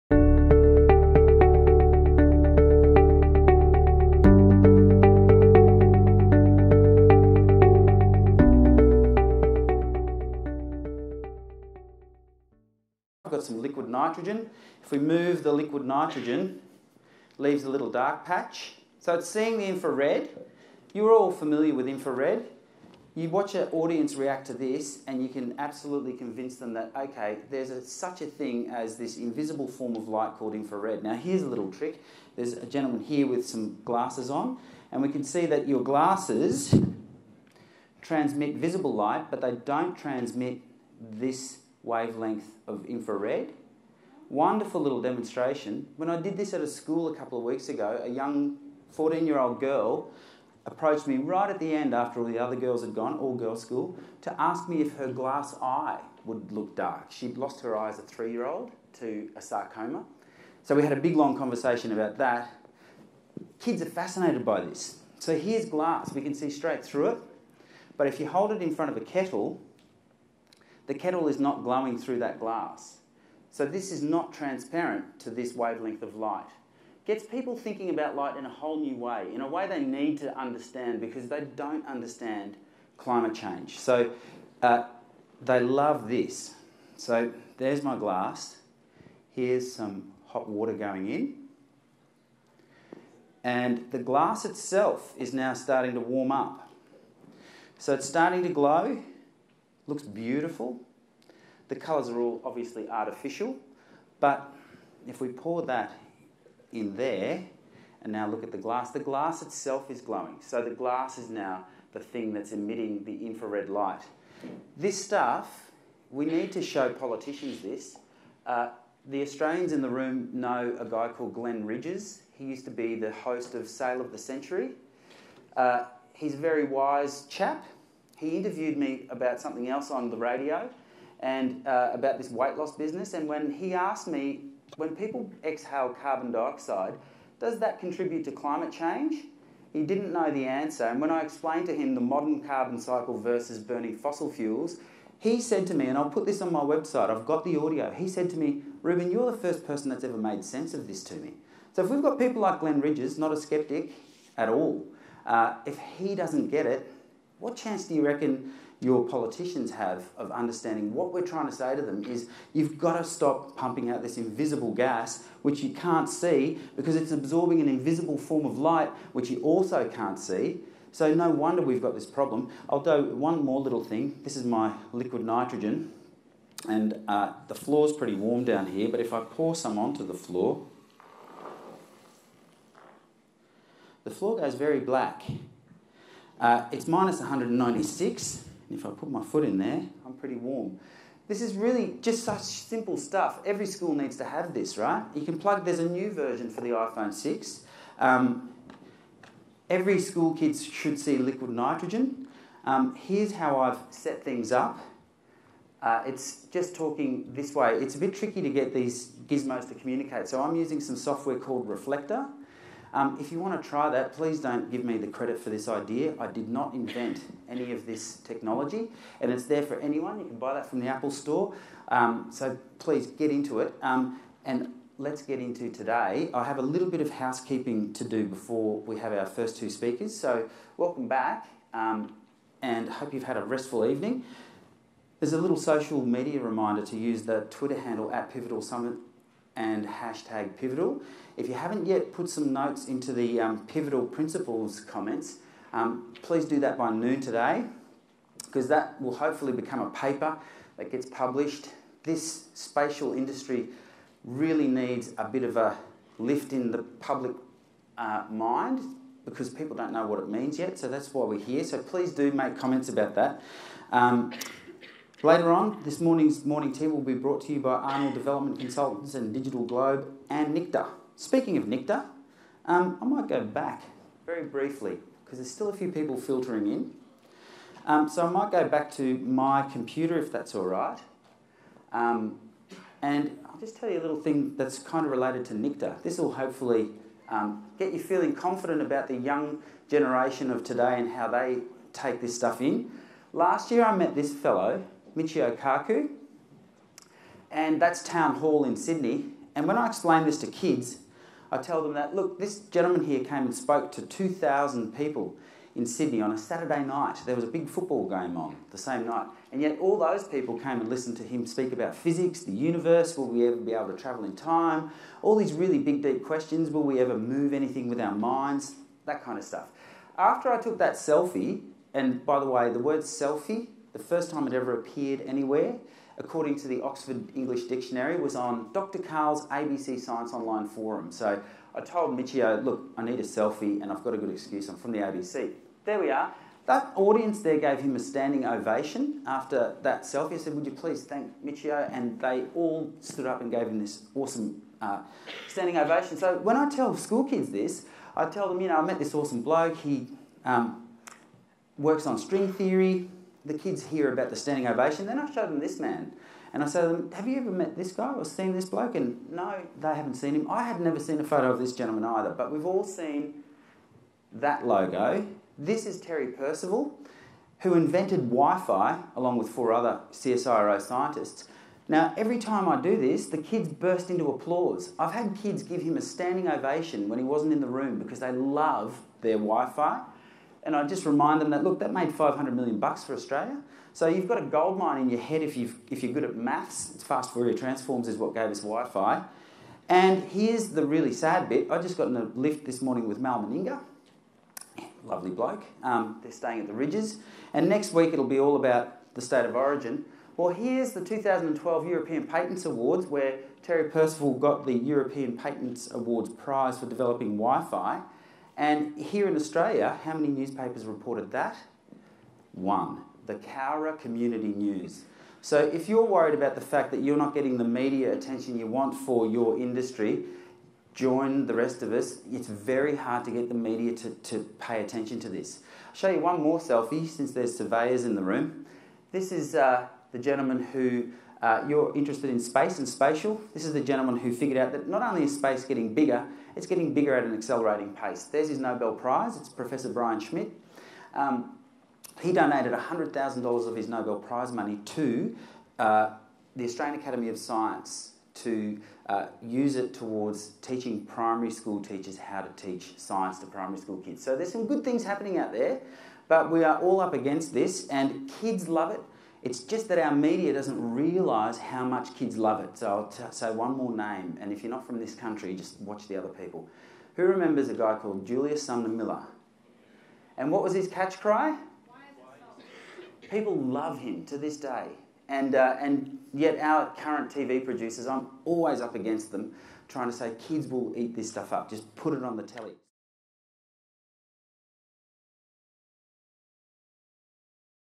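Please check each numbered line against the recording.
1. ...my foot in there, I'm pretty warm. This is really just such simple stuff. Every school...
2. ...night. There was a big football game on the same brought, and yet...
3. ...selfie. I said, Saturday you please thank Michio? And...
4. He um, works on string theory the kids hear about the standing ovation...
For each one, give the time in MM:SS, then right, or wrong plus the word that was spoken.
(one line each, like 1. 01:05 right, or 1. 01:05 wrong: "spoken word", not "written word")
1. 03:09 right
2. 05:06 wrong: "night", not "brought"
3. 05:40 wrong: "Would", not "Saturday"
4. 05:49 right.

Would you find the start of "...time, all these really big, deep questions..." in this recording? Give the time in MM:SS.
05:14.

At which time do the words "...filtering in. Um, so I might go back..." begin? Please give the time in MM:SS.
04:36.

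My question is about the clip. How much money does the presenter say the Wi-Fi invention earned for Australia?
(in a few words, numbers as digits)
$500 million.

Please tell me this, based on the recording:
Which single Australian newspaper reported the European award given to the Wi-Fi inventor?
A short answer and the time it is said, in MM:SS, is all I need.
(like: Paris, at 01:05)
Cowra Community News, at 06:53.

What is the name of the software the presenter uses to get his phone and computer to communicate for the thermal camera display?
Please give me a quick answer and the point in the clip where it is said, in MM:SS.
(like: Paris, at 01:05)
Reflector, at 03:31.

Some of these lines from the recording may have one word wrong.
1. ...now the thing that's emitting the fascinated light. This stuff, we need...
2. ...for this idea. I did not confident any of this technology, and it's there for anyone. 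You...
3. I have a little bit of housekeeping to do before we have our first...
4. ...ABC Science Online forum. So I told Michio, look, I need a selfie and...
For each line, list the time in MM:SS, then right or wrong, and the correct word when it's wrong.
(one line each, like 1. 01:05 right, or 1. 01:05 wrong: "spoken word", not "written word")
1. 01:51 wrong: "infrared", not "fascinated"
2. 03:35 wrong: "invent", not "confident"
3. 03:46 right
4. 05:29 right.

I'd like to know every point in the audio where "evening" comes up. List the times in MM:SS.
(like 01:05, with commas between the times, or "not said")
03:53.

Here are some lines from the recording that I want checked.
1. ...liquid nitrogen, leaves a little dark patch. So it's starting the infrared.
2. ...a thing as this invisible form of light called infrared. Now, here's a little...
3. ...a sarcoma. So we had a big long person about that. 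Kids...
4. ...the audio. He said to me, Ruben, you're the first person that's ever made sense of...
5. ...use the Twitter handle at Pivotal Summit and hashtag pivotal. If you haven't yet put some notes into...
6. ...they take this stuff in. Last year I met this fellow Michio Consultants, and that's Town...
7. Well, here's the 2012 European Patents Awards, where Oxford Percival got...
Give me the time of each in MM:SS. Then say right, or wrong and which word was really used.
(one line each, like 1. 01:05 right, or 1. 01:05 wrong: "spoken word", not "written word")
1. 00:15 wrong: "seeing", not "starting"
2. 00:28 right
3. 00:59 wrong: "conversation", not "person"
4. 02:27 right
5. 03:56 right
6. 04:51 wrong: "Kaku", not "Consultants"
7. 06:40 wrong: "Terry", not "Oxford".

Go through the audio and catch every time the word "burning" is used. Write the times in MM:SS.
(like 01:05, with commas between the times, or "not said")
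02:23.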